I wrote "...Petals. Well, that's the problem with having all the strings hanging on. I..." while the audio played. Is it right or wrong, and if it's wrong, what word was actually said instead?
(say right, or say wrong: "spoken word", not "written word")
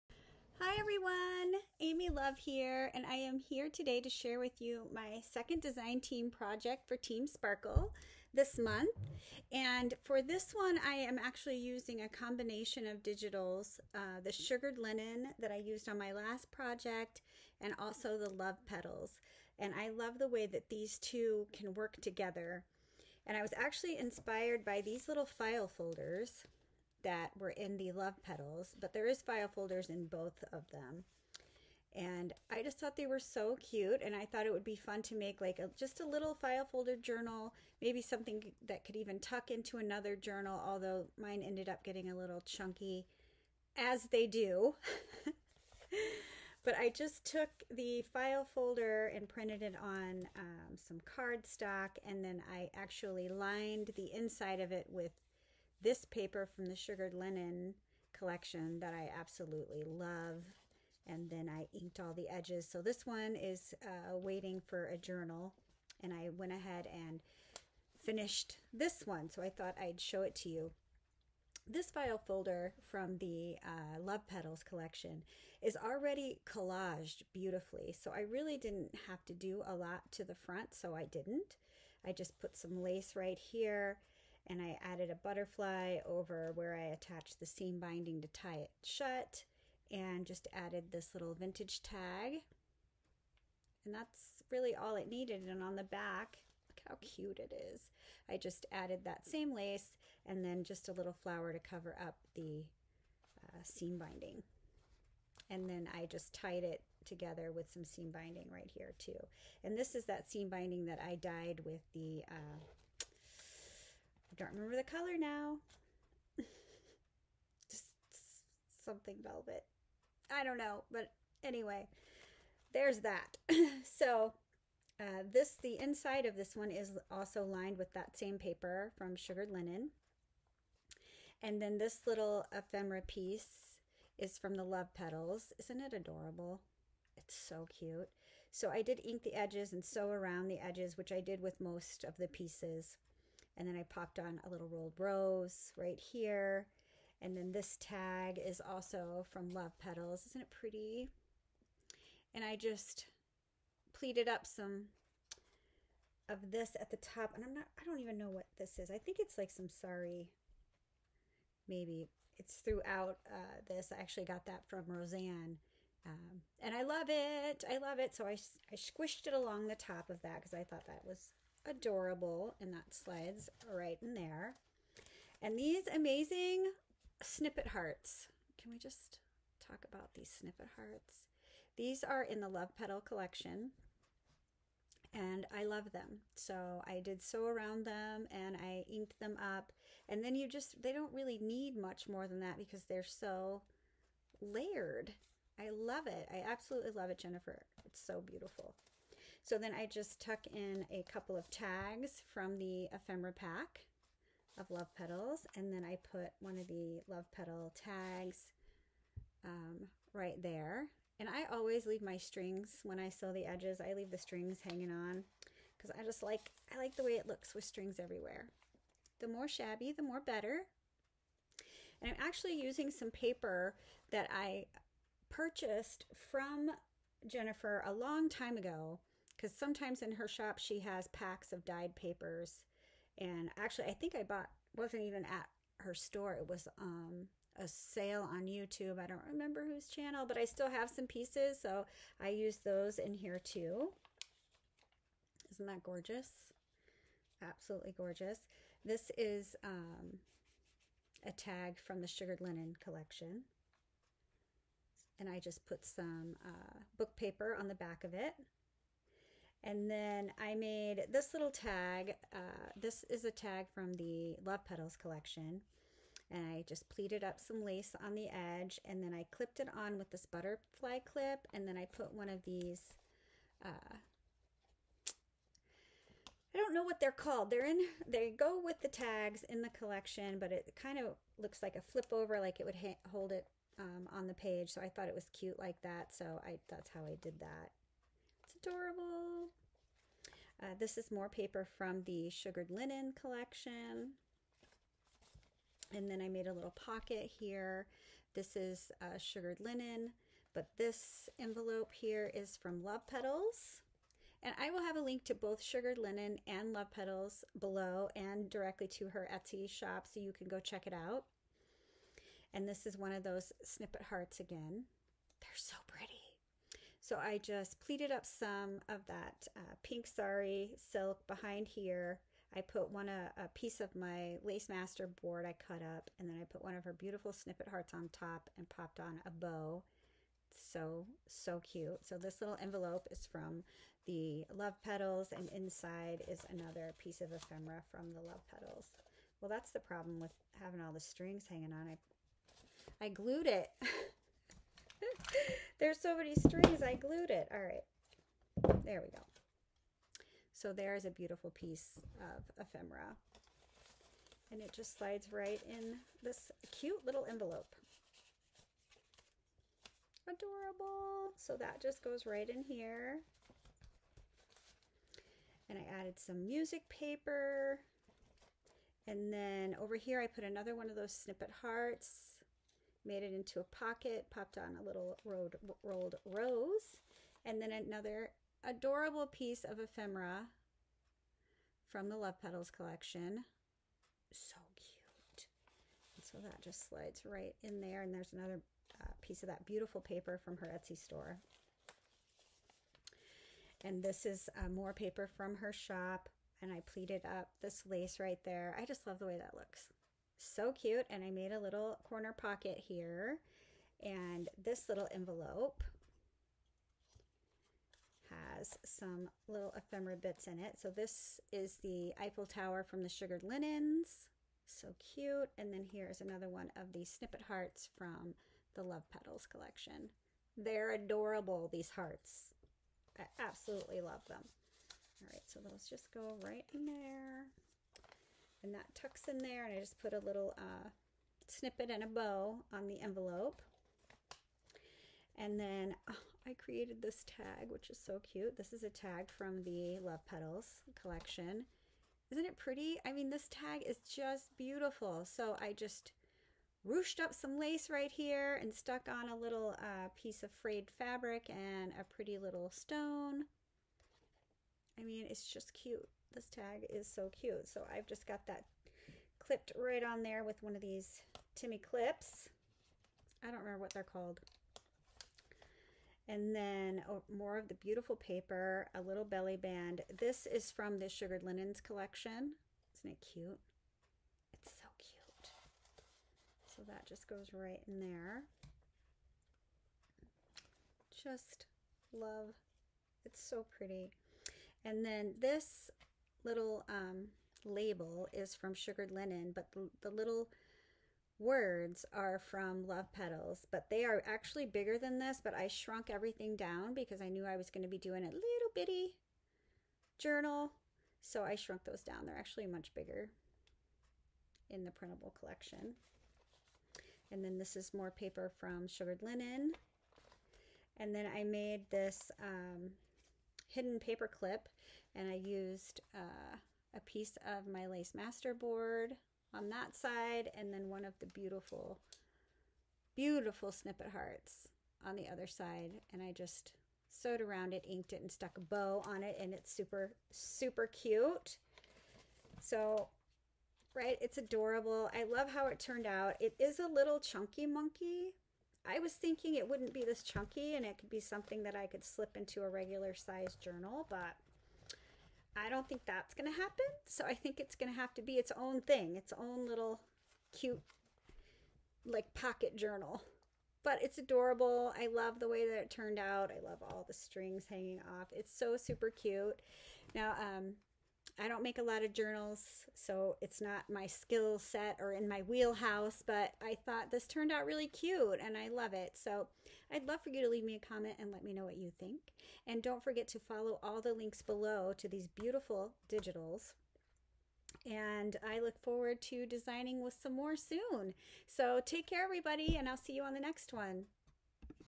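right.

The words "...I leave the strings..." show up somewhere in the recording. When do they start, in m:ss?
3:33.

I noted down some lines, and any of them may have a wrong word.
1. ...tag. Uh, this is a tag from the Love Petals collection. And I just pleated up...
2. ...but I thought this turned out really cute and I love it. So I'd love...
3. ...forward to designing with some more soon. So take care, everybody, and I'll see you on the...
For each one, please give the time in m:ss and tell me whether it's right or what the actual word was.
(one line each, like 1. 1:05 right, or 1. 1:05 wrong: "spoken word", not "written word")
1. 4:21 right
2. 9:26 right
3. 9:38 right.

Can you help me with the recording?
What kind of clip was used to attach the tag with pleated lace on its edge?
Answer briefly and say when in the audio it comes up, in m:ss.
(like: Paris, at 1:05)
Butterfly clip, at 4:30.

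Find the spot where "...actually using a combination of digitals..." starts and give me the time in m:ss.
0:11.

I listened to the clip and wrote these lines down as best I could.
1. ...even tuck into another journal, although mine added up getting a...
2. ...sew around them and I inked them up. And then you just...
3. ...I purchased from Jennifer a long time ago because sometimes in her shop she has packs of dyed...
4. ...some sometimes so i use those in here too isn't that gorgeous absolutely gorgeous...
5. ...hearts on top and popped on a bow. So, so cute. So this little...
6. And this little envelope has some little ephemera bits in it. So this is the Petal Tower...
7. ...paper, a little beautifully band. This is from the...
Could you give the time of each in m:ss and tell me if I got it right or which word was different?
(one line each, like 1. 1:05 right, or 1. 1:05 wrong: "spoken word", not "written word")
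1. 0:38 wrong: "ended", not "added"
2. 3:07 right
3. 3:44 right
4. 4:00 wrong: "pieces", not "sometimes"
5. 5:27 right
6. 6:44 wrong: "Eiffel", not "Petal"
7. 7:48 wrong: "belly", not "beautifully".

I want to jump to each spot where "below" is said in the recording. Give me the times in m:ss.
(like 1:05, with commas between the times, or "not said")
5:07, 9:34.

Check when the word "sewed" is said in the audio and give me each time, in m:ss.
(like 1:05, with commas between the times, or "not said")
8:47.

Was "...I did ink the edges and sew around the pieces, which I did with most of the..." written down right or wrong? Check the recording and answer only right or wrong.
wrong.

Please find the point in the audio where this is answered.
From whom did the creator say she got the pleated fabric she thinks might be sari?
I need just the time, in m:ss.
2:44.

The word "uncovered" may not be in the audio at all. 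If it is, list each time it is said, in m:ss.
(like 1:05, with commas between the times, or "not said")
not said.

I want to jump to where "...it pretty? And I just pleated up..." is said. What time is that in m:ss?
2:30.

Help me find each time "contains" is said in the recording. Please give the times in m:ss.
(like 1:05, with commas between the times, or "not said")
not said.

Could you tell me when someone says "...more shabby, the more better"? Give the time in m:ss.
3:39.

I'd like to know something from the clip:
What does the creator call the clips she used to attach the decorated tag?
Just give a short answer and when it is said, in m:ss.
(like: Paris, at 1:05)
Timmy clips, at 7:41.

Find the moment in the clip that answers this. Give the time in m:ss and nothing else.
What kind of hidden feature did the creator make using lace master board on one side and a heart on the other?
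8:33.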